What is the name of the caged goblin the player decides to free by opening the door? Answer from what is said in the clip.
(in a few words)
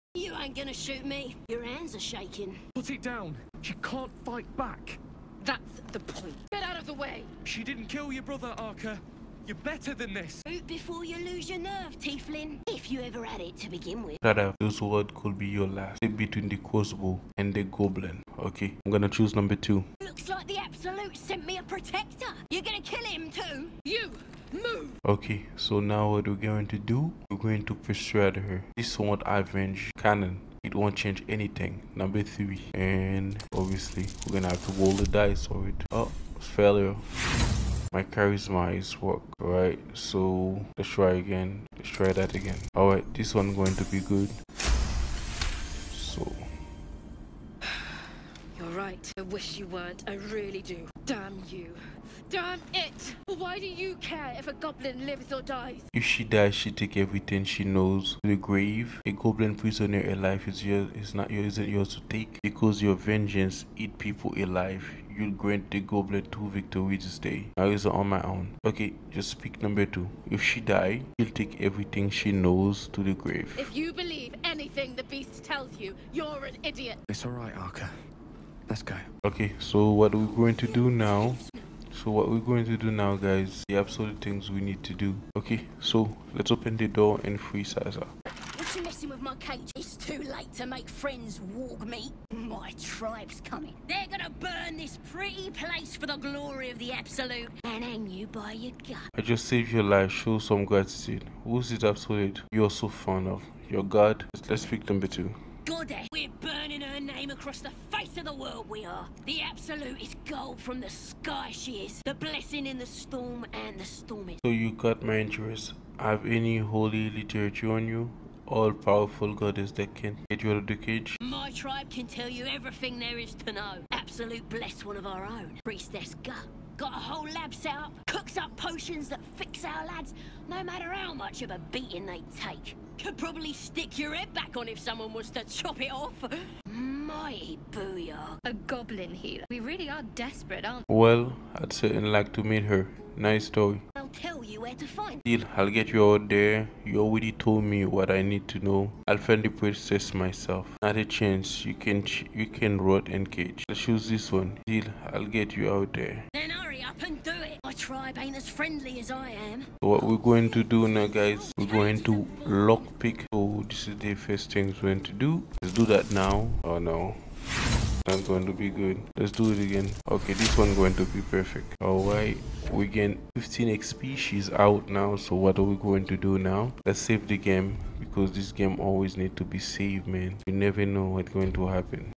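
Sazza.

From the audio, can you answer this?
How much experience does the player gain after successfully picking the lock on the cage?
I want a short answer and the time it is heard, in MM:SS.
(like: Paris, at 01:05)
15 XP, at 02:53.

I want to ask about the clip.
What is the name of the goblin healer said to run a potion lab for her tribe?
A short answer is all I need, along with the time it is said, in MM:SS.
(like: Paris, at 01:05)
Priestess Gut, at 02:05.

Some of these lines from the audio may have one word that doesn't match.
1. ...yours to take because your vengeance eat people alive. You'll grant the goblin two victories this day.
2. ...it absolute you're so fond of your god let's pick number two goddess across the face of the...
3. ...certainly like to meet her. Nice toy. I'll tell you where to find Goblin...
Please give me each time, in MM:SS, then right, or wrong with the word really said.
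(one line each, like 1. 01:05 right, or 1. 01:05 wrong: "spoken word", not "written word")
1. 01:01 right
2. 01:41 right
3. 02:21 wrong: "Deal", not "Goblin".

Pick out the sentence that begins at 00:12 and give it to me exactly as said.
If you ever had it to begin with.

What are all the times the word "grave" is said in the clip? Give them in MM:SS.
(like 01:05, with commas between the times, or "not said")
00:58, 01:13.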